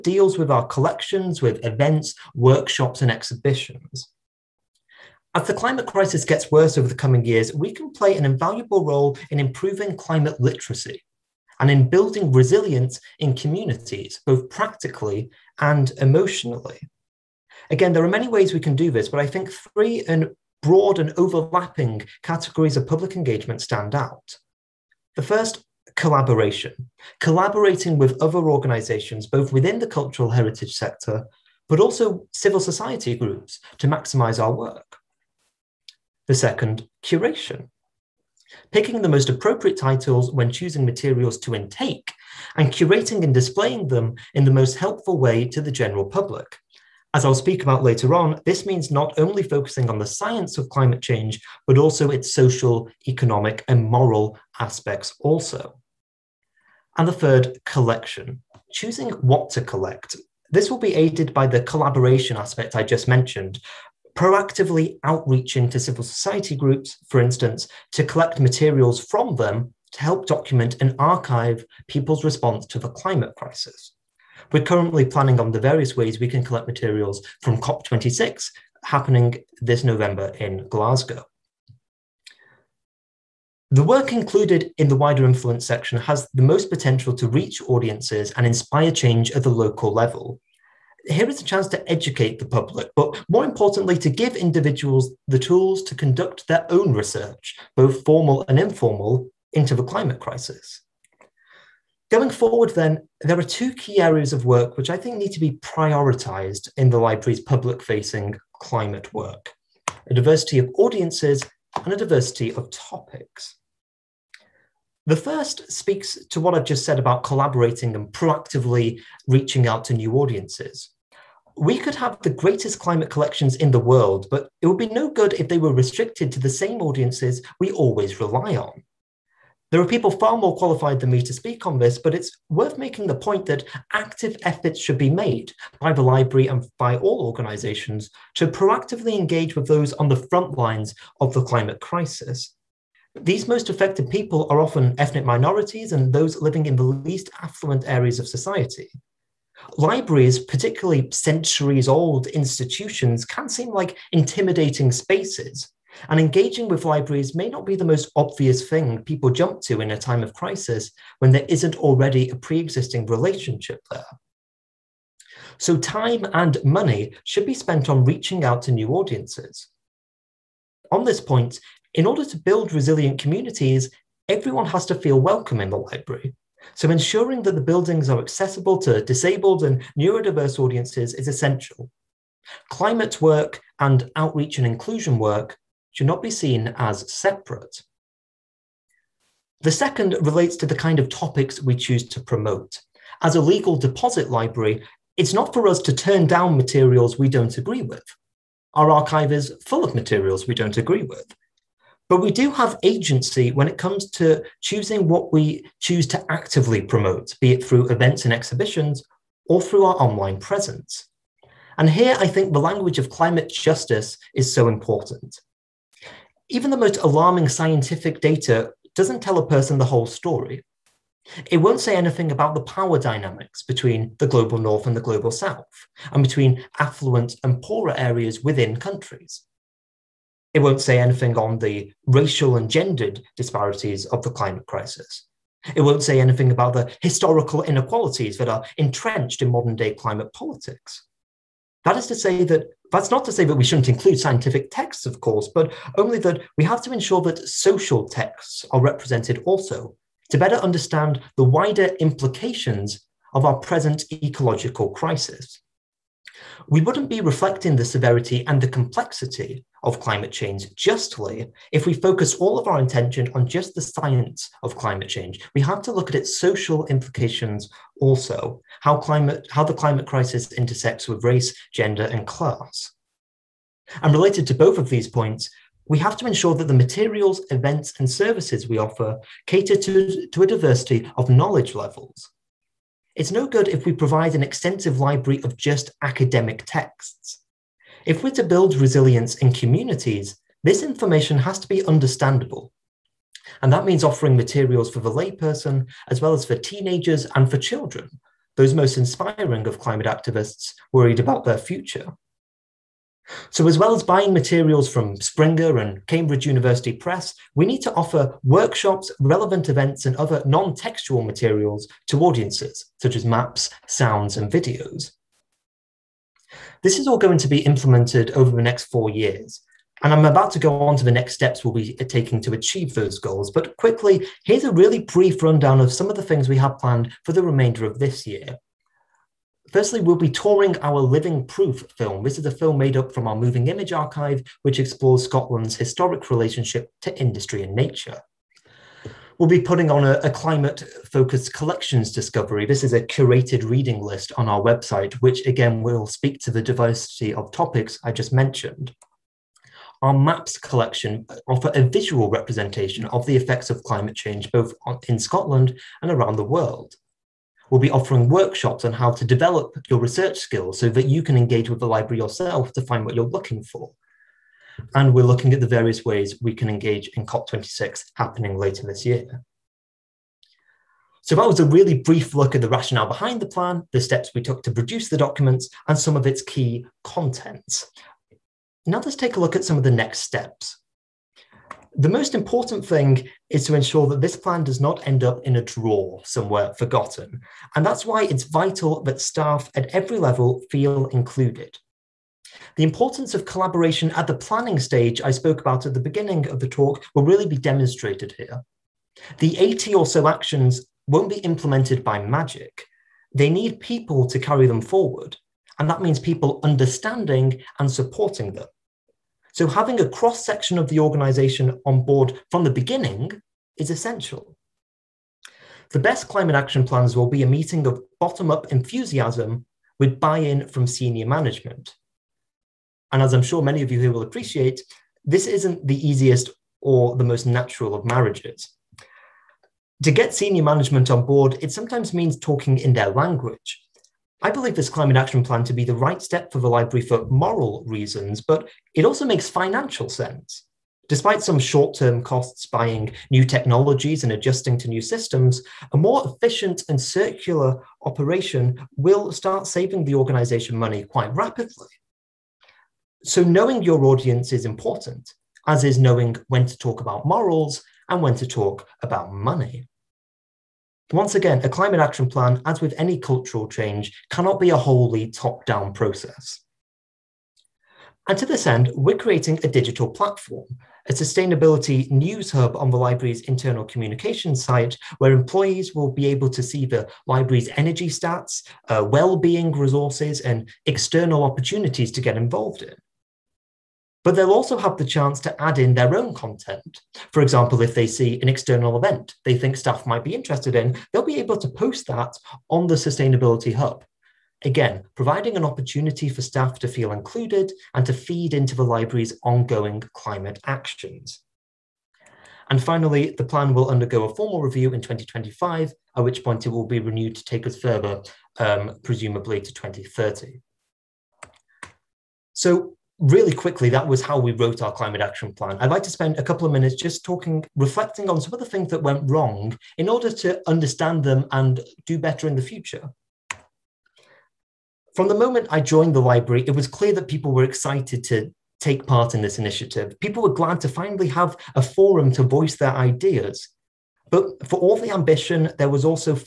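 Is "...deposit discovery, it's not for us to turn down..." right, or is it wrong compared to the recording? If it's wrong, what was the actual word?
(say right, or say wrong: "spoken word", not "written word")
wrong: "library", not "discovery".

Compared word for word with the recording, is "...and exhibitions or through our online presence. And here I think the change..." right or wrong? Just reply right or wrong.
wrong.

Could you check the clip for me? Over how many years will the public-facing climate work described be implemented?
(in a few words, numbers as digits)
4 years.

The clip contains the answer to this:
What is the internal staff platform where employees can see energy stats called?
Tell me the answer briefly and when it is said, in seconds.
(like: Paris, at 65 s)
sustainability news hub, at 471 s.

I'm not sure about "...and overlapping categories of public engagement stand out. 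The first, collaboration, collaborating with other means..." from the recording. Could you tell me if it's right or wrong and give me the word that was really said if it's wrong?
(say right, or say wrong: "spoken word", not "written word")
wrong: "organizations", not "means".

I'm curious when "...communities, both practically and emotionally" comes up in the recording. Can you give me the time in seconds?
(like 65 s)
13 s.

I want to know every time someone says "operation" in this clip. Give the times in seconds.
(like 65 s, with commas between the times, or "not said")
448 s.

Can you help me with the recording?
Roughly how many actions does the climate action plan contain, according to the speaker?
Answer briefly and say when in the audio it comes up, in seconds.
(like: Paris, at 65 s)
80, at 399 s.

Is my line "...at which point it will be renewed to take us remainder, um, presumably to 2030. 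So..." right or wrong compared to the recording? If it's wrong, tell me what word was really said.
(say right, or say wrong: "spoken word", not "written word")
wrong: "further", not "remainder".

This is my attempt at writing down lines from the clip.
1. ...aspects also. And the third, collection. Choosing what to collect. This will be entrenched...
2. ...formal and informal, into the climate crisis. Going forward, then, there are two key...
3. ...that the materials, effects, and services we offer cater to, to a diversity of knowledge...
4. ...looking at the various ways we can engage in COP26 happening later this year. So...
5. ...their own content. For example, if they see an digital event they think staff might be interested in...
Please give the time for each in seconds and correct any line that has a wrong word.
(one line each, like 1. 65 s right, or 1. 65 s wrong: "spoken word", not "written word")
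1. 54 s wrong: "aided", not "entrenched"
2. 98 s right
3. 276 s wrong: "events", not "effects"
4. 365 s right
5. 485 s wrong: "external", not "digital".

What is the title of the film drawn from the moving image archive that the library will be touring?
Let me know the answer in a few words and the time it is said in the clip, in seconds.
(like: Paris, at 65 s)
Living Proof, at 330 s.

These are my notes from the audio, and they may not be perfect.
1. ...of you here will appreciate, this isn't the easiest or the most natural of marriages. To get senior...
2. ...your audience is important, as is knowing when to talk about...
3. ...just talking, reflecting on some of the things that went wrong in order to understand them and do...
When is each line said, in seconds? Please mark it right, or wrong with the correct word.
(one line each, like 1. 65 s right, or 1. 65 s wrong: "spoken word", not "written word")
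1. 423 s right
2. 453 s right
3. 516 s right.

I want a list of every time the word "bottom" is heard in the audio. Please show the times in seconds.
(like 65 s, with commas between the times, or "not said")
418 s.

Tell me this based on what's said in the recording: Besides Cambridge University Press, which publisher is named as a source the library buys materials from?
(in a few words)
Springer.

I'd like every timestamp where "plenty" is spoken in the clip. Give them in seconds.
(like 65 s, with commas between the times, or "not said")
not said.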